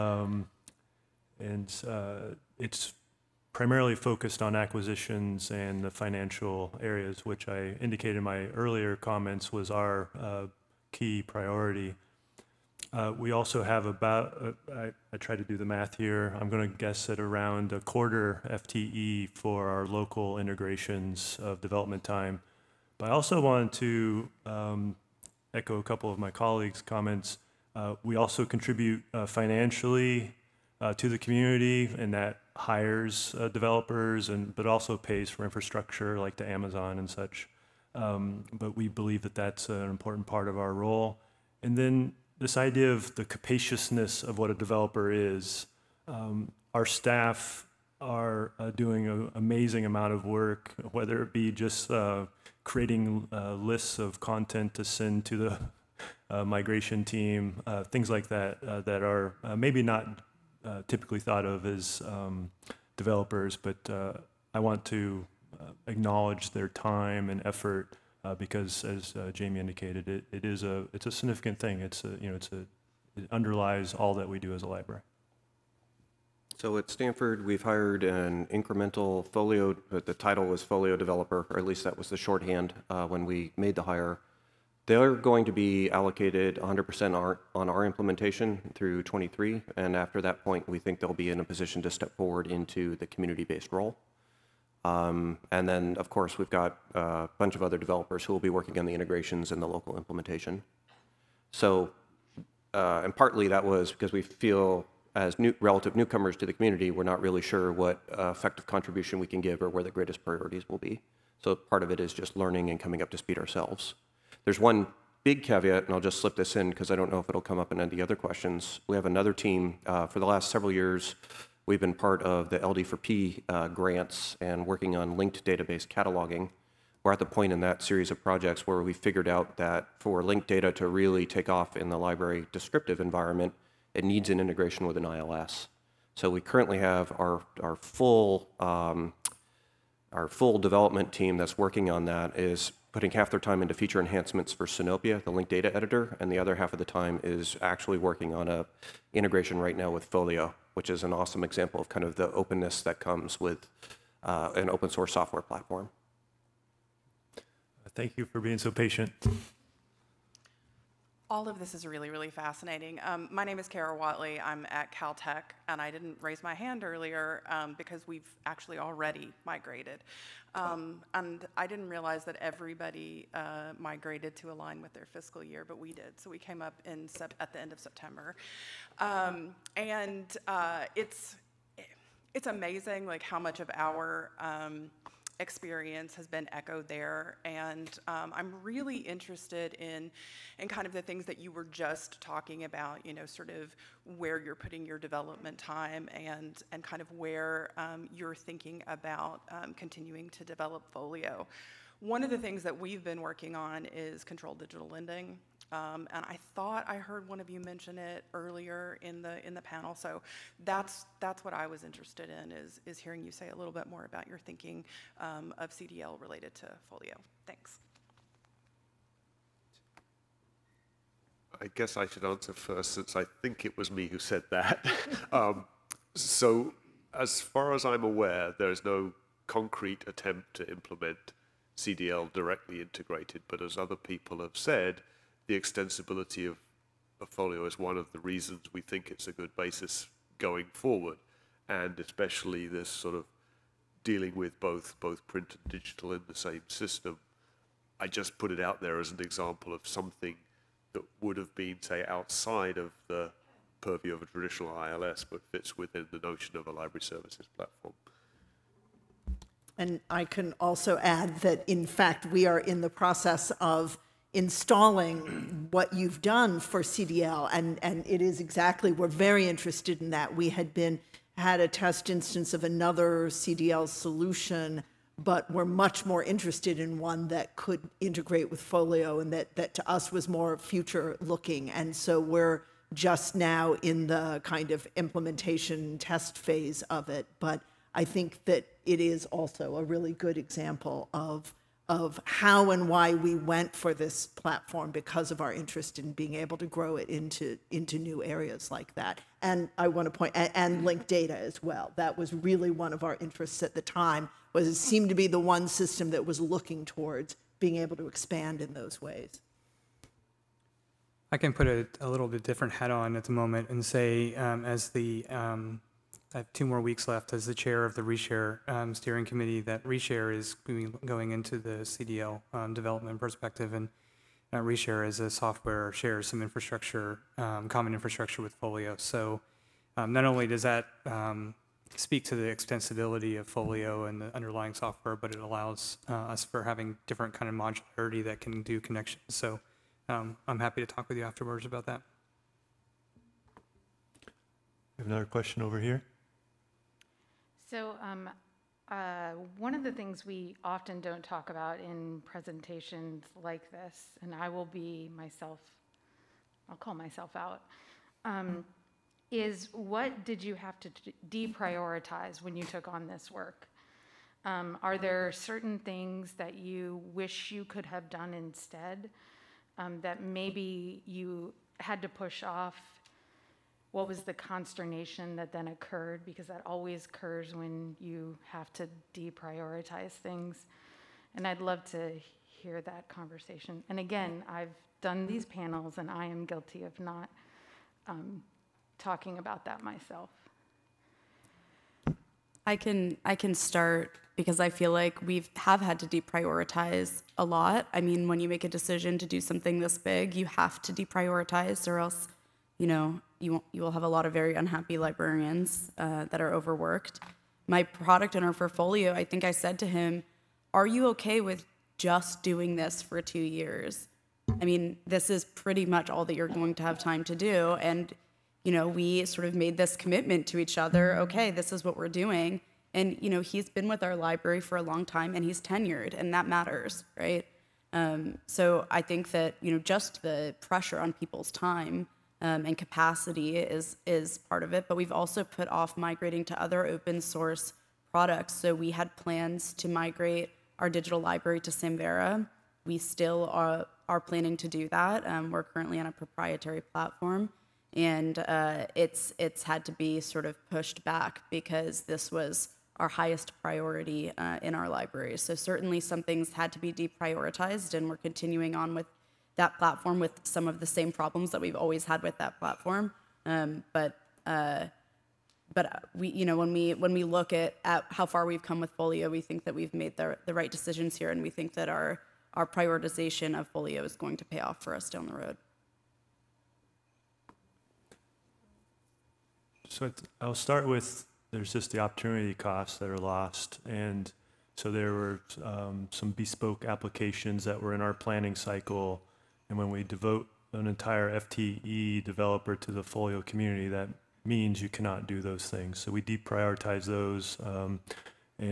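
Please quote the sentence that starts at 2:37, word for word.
Thank you for being so patient.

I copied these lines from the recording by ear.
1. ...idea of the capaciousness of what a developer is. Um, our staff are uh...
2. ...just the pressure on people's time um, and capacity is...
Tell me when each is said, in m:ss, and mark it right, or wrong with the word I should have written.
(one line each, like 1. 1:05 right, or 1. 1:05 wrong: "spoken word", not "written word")
1. 0:42 right
2. 7:09 right.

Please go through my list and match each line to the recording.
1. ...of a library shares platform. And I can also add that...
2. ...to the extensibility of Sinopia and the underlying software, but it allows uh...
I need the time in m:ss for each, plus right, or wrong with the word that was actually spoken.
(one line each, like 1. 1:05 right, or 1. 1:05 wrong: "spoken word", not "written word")
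1. 4:16 wrong: "services", not "shares"
2. 5:32 wrong: "Folio", not "Sinopia".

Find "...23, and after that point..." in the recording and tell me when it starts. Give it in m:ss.
1:29.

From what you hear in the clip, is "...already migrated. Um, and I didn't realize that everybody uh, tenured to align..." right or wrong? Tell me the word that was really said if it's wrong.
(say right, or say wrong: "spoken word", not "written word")
wrong: "migrated", not "tenured".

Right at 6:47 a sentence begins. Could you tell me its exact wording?
My product owner for Folio, I think I said to him, Are you okay with just doing this for two years?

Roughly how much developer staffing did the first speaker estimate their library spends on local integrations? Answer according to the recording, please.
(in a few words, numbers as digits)
a quarter FTE.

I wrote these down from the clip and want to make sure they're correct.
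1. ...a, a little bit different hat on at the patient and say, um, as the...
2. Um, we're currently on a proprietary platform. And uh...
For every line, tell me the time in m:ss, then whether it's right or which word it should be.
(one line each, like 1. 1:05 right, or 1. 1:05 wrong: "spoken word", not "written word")
1. 5:11 wrong: "moment", not "patient"
2. 7:25 right.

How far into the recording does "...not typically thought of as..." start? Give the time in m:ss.
0:59.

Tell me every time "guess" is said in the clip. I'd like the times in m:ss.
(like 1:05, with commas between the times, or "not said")
0:16, 3:41.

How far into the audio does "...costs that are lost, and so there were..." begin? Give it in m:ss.
8:02.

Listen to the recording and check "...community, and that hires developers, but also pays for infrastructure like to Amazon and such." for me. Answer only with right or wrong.
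right.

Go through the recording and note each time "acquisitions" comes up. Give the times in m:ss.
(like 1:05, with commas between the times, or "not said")
0:04.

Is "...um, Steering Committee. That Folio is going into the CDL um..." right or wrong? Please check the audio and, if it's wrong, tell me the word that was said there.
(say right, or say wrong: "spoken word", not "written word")
wrong: "Reshare", not "Folio".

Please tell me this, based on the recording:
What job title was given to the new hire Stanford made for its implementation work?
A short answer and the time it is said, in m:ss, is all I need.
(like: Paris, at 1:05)
folio developer, at 1:20.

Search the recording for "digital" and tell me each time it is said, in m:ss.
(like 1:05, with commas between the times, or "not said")
3:24, 4:05, 7:20.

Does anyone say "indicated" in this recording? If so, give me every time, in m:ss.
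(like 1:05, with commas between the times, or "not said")
0:07, 1:09.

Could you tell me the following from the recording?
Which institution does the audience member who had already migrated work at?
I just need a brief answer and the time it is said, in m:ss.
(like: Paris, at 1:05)
Caltech, at 2:44.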